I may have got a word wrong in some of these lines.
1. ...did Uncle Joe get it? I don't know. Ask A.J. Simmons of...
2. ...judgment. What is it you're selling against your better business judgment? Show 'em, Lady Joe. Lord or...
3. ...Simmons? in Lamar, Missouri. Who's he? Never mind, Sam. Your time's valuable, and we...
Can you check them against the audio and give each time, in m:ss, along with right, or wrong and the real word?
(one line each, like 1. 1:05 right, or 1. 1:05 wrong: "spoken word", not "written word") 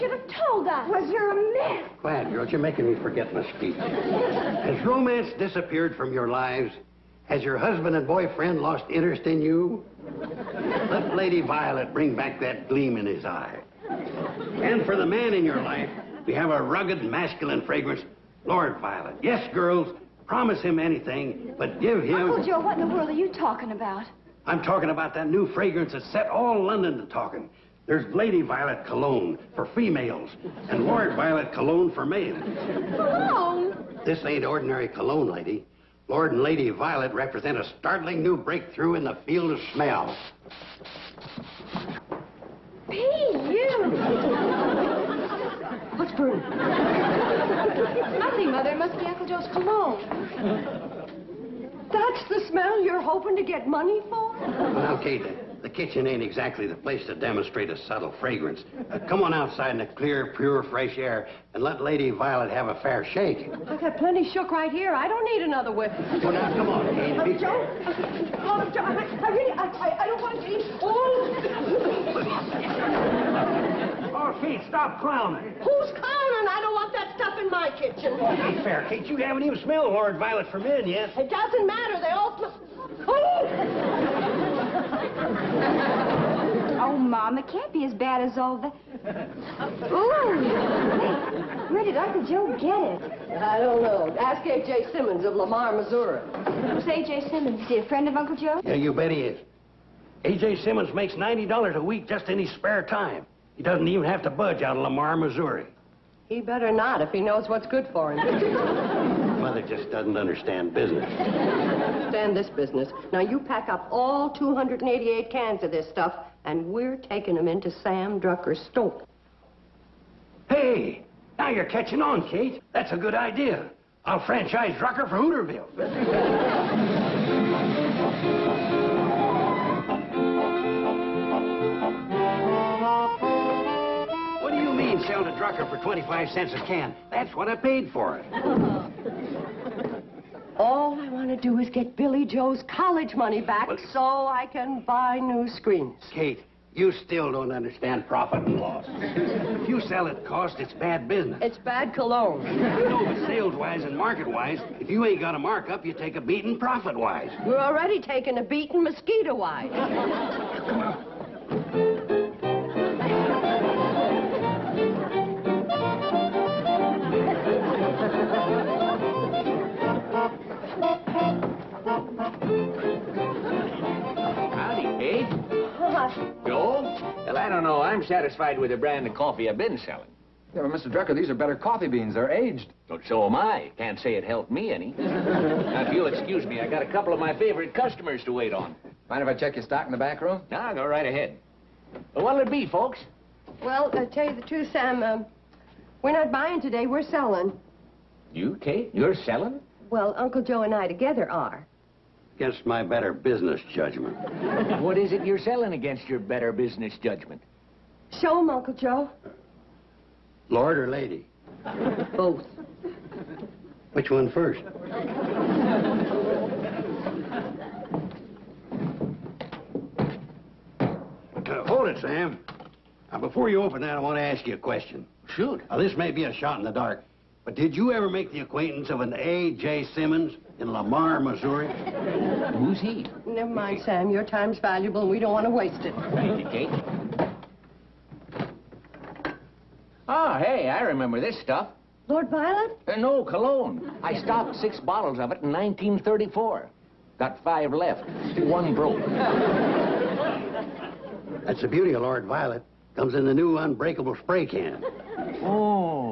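1. 1:31 right
2. 3:23 wrong: "Uncle", not "Lady"
3. 3:49 right.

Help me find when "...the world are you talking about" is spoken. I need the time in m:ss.
0:22.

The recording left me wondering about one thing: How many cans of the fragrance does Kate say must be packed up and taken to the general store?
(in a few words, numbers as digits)
288.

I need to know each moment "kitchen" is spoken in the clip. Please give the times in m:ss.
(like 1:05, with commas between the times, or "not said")
0:55, 1:17.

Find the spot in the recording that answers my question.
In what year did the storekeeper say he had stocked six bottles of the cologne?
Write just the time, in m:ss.
4:05.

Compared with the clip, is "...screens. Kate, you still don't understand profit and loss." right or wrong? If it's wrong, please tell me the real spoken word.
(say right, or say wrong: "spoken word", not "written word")
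right.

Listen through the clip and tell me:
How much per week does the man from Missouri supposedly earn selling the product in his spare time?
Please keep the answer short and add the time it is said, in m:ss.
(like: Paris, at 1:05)
$90, at 1:41.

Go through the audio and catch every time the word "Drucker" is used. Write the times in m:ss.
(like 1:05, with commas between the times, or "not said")
1:58, 2:04, 2:15, 3:00.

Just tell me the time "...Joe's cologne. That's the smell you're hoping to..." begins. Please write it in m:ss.
0:49.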